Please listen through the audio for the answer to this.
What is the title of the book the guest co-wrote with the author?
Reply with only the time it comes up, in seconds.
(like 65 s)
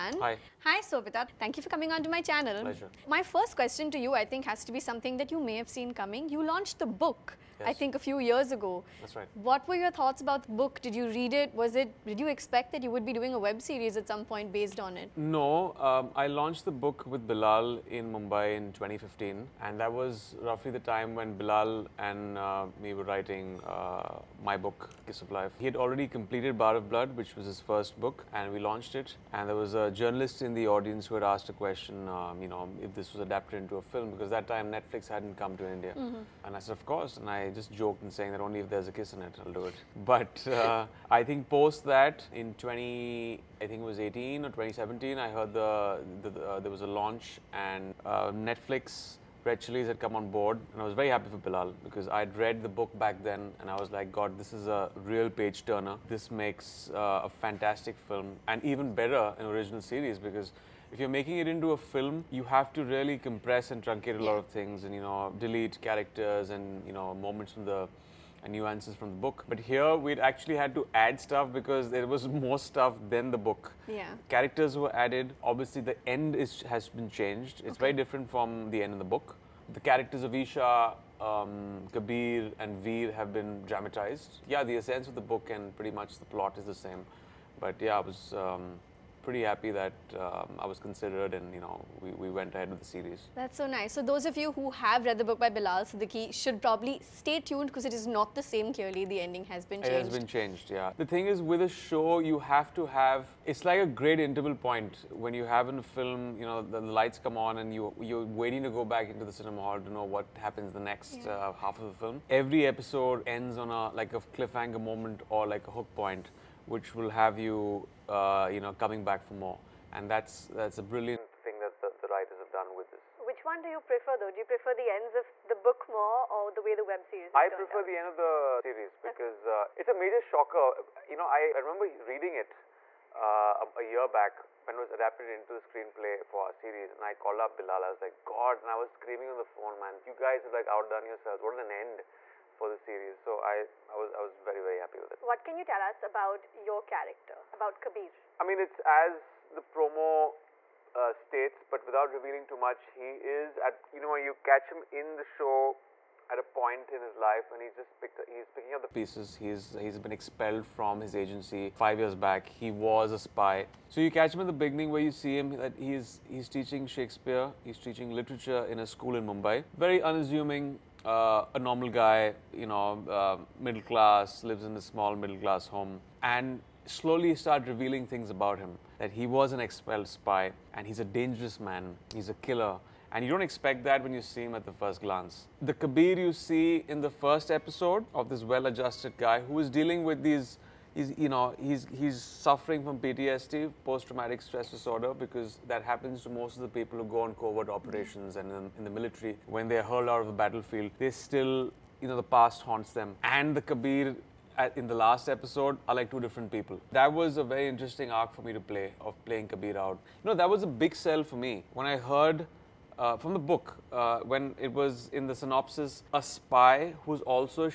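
25 s.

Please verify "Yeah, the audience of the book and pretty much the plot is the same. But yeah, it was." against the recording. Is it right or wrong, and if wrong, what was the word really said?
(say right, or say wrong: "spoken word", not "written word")
wrong: "essence", not "audience".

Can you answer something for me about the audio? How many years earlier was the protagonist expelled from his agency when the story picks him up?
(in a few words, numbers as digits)
5.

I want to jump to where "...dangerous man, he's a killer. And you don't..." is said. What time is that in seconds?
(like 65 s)
181 s.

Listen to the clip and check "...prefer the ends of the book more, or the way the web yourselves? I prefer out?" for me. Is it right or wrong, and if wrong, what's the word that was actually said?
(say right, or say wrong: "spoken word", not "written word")
wrong: "series", not "yourselves".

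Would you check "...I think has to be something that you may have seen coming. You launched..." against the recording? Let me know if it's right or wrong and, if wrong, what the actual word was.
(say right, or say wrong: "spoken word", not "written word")
right.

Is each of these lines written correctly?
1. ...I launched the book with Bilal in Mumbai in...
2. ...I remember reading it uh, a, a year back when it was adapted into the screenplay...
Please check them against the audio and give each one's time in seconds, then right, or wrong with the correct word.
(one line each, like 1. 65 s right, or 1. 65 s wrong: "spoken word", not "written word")
1. 16 s right
2. 131 s right.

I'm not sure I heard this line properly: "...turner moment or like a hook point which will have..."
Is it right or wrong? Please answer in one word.
wrong.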